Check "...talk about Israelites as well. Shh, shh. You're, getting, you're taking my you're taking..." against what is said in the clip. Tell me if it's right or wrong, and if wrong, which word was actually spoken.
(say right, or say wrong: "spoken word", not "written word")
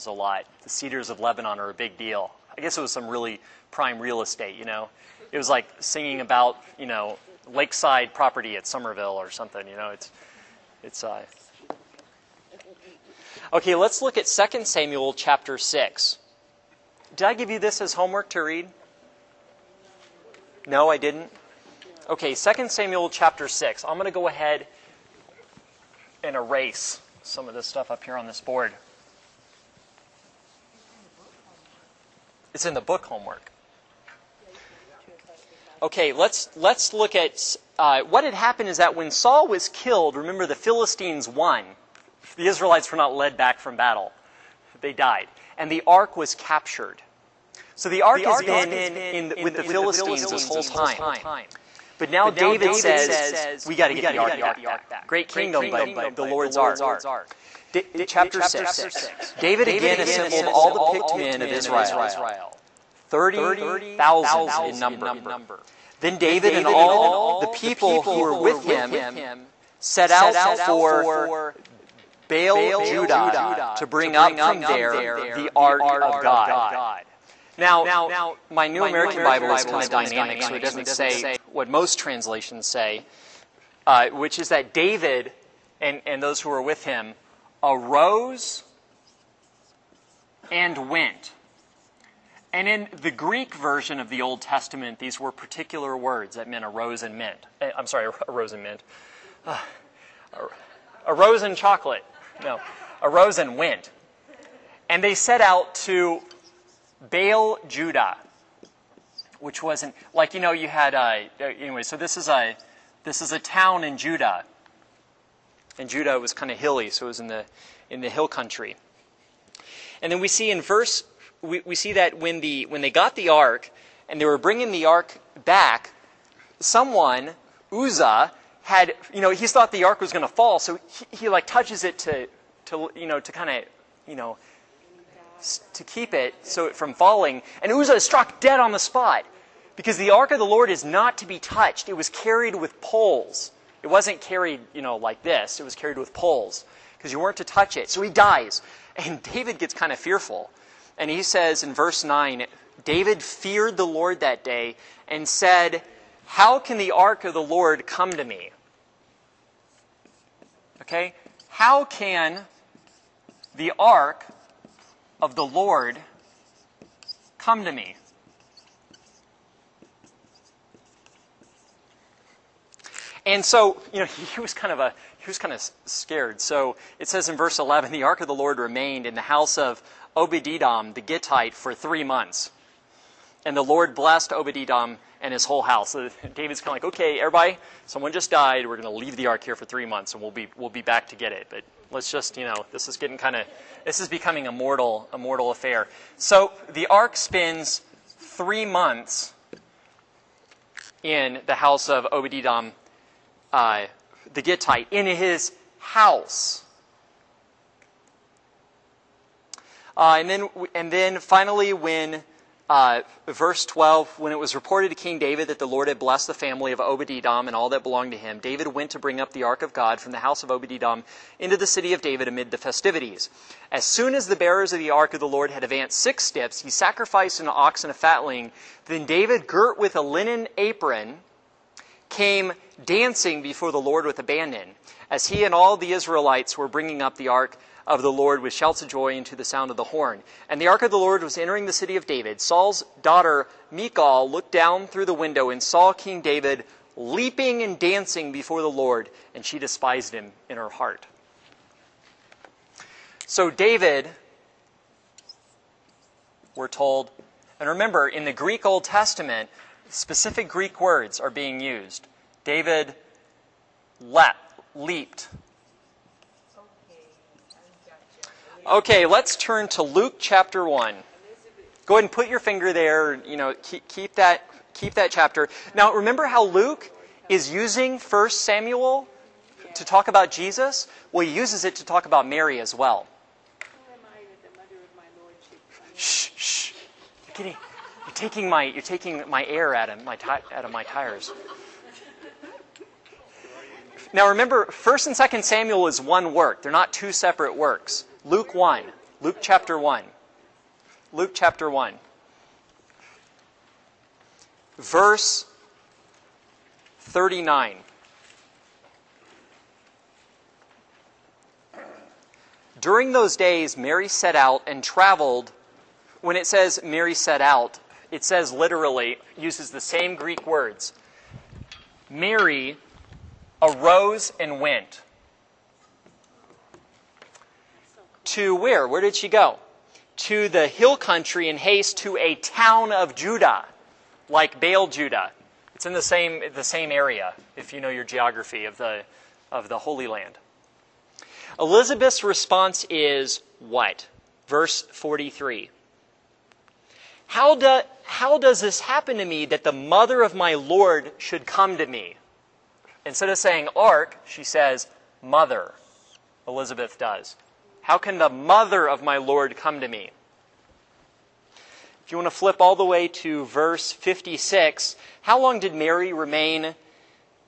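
wrong: "Mary", not "Israelites".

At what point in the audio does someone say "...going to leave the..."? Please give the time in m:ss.
3:08.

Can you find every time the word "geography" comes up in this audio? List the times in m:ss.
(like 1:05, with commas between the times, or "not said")
5:38.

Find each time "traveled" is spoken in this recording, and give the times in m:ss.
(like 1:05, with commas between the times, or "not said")
5:14.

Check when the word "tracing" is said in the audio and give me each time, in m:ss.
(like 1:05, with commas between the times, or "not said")
not said.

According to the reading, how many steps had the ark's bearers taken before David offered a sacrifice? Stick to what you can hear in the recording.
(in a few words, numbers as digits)
6.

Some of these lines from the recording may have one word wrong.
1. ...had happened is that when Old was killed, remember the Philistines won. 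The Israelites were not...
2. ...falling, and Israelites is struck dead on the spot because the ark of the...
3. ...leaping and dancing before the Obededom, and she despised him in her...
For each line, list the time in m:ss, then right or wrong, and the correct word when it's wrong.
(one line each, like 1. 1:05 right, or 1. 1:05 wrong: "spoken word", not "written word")
1. 0:38 wrong: "Saul", not "Old"
2. 2:16 wrong: "Uzzah", not "Israelites"
3. 4:06 wrong: "Lord", not "Obededom".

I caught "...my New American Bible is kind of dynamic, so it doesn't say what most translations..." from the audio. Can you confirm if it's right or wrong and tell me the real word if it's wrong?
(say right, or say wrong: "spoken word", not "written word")
right.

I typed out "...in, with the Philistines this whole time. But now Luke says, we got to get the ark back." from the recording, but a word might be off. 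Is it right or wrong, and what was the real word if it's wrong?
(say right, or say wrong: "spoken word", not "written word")
wrong: "David", not "Luke".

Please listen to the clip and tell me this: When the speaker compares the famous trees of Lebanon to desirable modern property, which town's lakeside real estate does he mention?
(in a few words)
Somerville.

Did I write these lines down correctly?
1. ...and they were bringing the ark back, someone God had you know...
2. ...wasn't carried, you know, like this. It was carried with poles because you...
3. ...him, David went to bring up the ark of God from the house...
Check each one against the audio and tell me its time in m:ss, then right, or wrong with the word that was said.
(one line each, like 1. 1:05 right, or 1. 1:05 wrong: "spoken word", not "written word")
1. 2:04 wrong: "Uzzah", not "God"
2. 2:23 right
3. 3:38 right.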